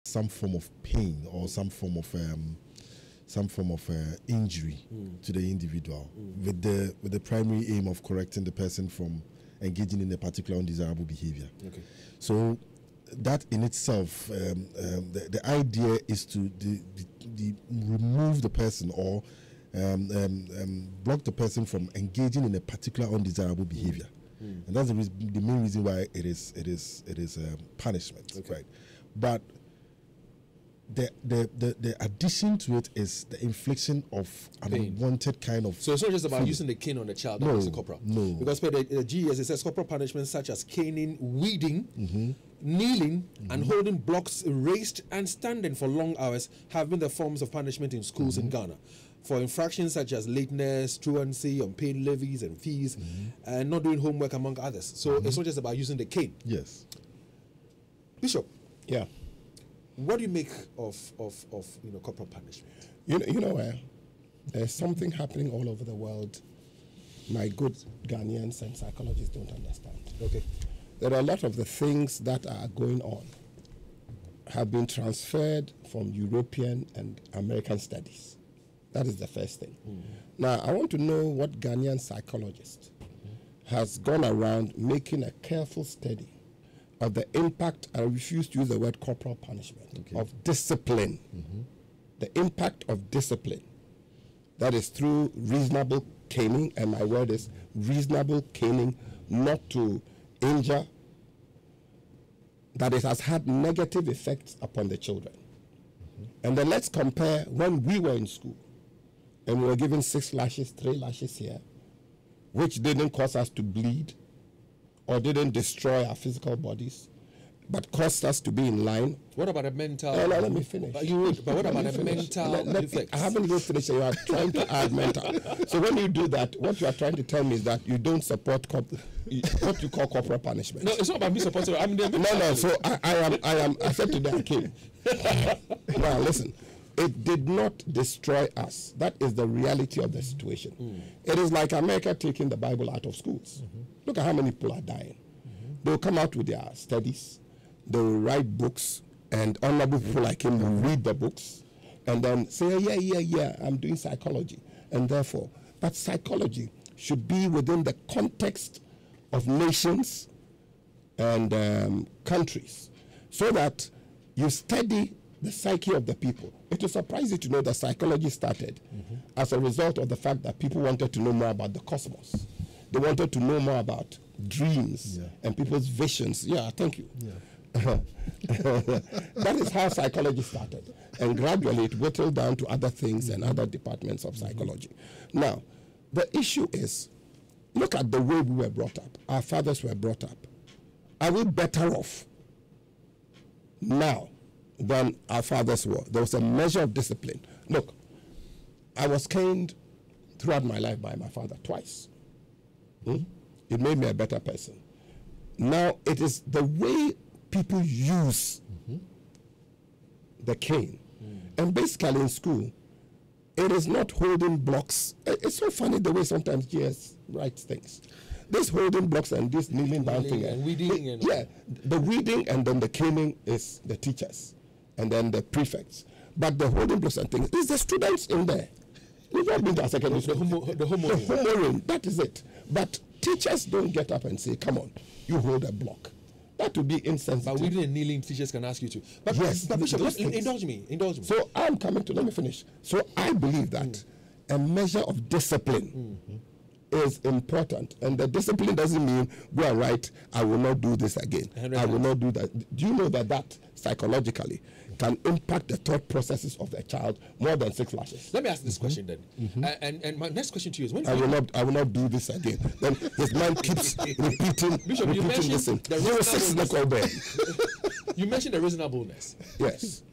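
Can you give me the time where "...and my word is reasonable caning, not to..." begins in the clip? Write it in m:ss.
1:36.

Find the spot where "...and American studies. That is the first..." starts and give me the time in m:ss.
1:16.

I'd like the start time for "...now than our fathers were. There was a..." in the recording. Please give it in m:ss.
3:13.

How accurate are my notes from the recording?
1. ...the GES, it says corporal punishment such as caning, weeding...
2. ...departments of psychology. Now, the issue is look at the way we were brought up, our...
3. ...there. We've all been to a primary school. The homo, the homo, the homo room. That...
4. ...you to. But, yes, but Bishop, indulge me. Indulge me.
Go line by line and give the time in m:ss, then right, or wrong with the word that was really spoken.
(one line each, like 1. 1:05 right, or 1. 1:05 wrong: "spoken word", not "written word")
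1. 0:38 right
2. 3:03 right
3. 3:48 wrong: "secondary", not "primary"
4. 3:58 right.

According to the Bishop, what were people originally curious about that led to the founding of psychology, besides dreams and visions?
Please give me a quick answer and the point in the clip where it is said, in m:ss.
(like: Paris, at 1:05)
The cosmos, at 2:51.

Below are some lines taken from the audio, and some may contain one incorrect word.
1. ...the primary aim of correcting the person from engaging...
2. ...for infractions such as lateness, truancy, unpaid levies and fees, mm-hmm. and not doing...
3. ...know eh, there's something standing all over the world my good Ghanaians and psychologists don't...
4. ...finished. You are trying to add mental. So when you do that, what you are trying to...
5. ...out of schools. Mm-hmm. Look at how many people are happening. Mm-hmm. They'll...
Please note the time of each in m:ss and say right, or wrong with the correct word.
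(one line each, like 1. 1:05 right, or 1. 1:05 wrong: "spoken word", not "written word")
1. 0:07 right
2. 0:49 right
3. 1:03 wrong: "happening", not "standing"
4. 2:03 right
5. 2:22 wrong: "dying", not "happening".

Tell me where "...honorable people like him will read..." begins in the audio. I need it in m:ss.
2:29.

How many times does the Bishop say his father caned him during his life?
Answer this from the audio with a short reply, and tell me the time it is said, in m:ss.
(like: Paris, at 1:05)
2, at 3:21.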